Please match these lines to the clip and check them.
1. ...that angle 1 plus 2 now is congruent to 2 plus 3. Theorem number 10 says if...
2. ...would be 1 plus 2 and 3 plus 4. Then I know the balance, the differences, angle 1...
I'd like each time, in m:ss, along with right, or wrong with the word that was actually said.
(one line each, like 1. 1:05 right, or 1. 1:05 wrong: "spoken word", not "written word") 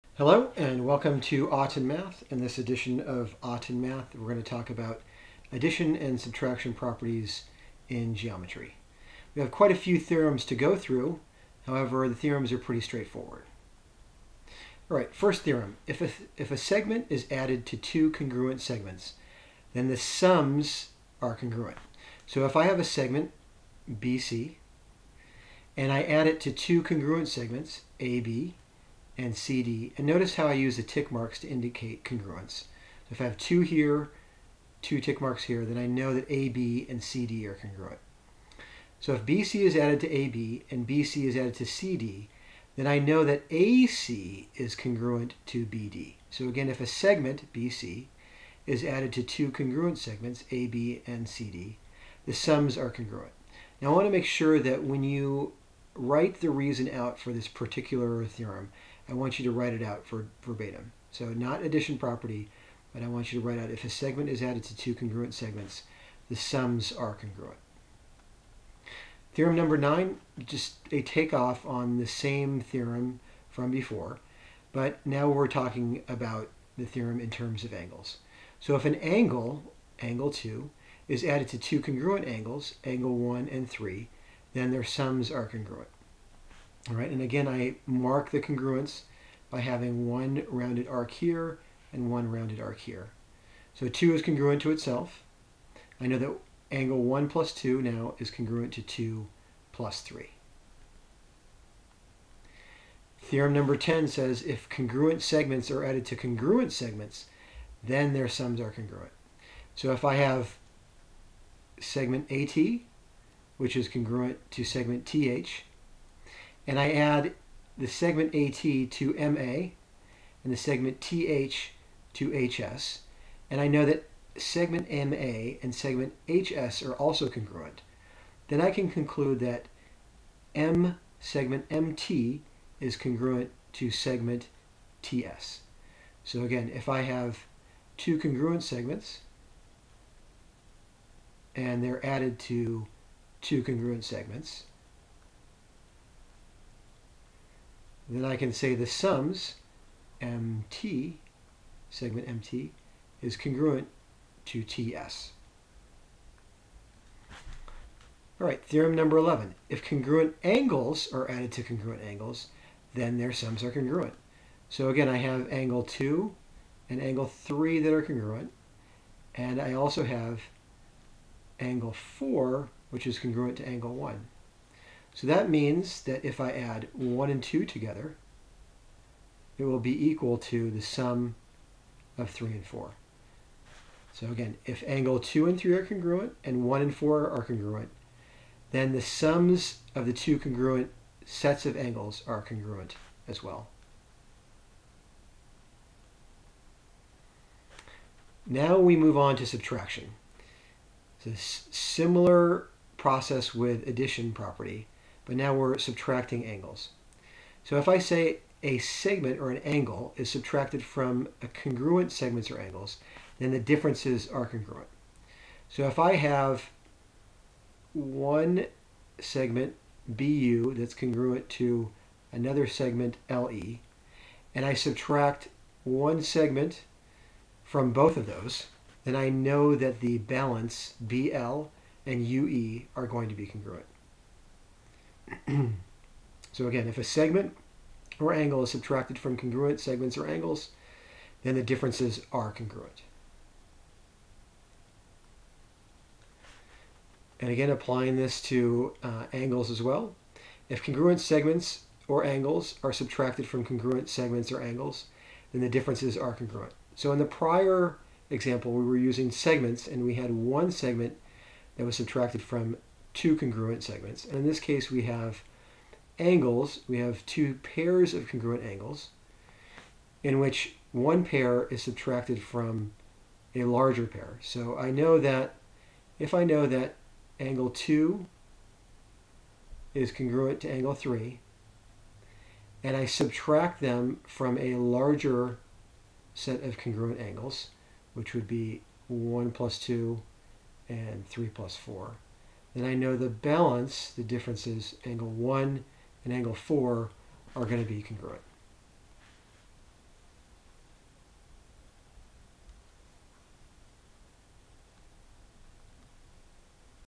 1. 1:36 right
2. 4:48 right.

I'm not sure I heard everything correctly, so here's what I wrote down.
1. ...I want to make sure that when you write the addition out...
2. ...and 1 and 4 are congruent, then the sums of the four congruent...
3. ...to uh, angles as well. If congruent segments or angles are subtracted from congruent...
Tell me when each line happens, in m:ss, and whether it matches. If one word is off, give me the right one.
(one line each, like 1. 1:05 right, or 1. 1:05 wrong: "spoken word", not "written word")
1. 0:53 wrong: "reason", not "addition"
2. 3:06 wrong: "two", not "four"
3. 4:08 right.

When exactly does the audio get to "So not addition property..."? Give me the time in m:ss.
1:01.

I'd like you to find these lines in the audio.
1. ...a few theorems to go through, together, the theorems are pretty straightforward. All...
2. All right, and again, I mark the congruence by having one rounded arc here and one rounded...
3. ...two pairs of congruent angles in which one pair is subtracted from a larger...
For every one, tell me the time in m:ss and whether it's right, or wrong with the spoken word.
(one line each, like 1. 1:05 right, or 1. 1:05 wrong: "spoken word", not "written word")
1. 0:09 wrong: "however", not "together"
2. 1:26 right
3. 4:27 right.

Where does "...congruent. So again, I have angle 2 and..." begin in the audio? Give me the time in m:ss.
2:43.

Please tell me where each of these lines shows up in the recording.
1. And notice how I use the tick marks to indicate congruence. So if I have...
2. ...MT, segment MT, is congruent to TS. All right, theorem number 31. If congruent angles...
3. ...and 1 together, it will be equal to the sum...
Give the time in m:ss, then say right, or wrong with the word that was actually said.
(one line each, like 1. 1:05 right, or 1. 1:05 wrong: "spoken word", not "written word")
1. 0:29 right
2. 2:30 wrong: "11", not "31"
3. 2:57 wrong: "2", not "1".